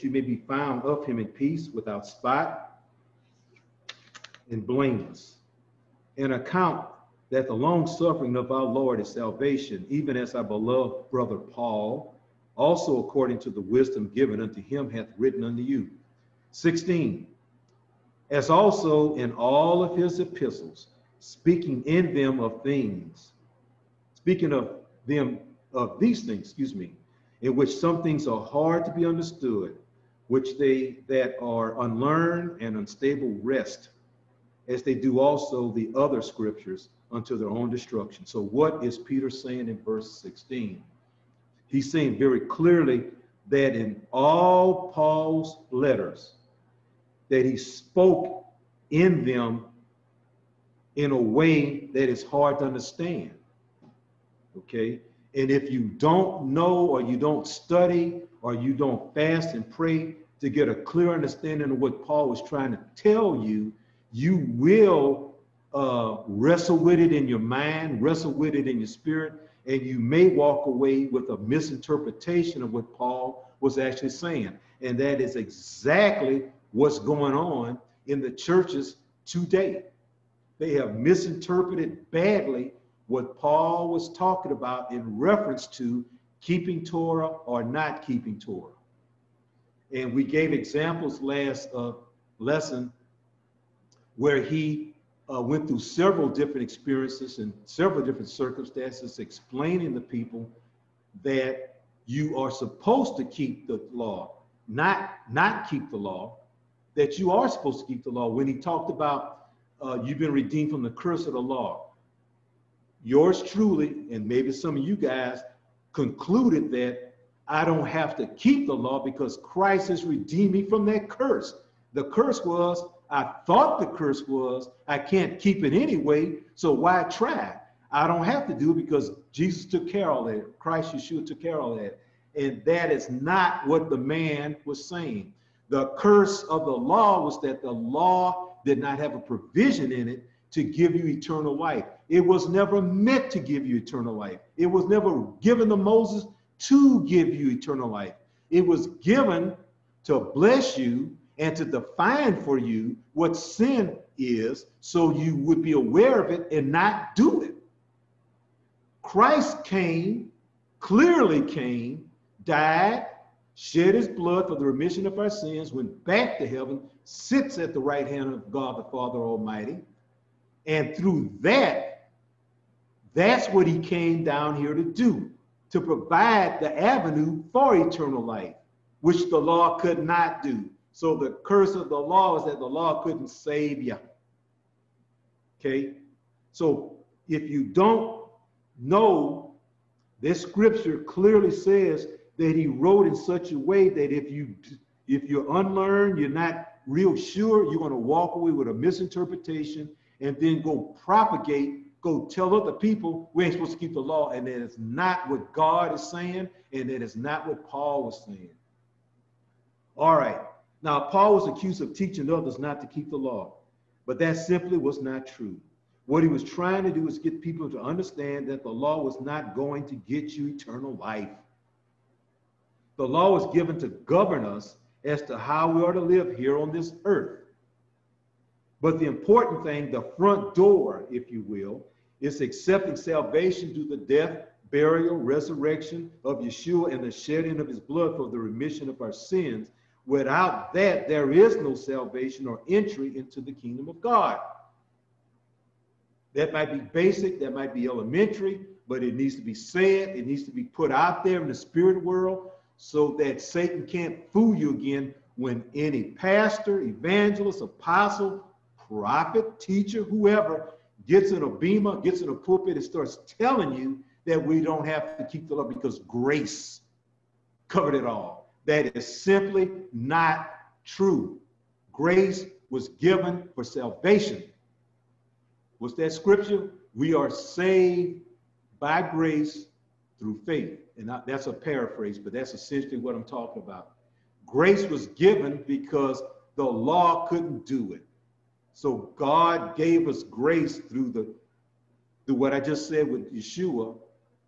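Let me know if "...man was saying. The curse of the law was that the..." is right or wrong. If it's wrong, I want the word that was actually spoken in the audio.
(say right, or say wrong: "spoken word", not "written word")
right.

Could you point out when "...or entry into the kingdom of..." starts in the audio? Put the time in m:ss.
4:02.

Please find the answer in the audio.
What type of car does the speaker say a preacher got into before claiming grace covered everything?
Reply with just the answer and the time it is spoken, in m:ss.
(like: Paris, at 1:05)
Beamer, at 4:21.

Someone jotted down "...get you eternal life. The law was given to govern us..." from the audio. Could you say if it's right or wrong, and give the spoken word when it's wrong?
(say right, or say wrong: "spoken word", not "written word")
right.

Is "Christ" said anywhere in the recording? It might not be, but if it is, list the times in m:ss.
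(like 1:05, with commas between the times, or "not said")
1:59, 2:10, 2:39.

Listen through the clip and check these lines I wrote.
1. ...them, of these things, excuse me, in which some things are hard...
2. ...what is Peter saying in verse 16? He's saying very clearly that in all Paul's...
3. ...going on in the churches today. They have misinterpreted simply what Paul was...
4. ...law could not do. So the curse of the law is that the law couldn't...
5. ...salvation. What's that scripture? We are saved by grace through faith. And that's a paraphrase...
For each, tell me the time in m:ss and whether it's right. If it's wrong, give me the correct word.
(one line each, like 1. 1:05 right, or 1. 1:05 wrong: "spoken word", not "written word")
1. 0:25 right
2. 0:38 right
3. 1:16 wrong: "badly", not "simply"
4. 2:59 right
5. 4:33 right.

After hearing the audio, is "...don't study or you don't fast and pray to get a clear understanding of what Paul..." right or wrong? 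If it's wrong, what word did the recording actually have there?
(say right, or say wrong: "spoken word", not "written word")
right.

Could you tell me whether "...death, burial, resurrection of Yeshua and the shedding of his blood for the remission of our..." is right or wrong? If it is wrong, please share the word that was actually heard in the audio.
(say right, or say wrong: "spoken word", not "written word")
right.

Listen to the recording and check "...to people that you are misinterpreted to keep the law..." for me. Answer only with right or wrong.
wrong.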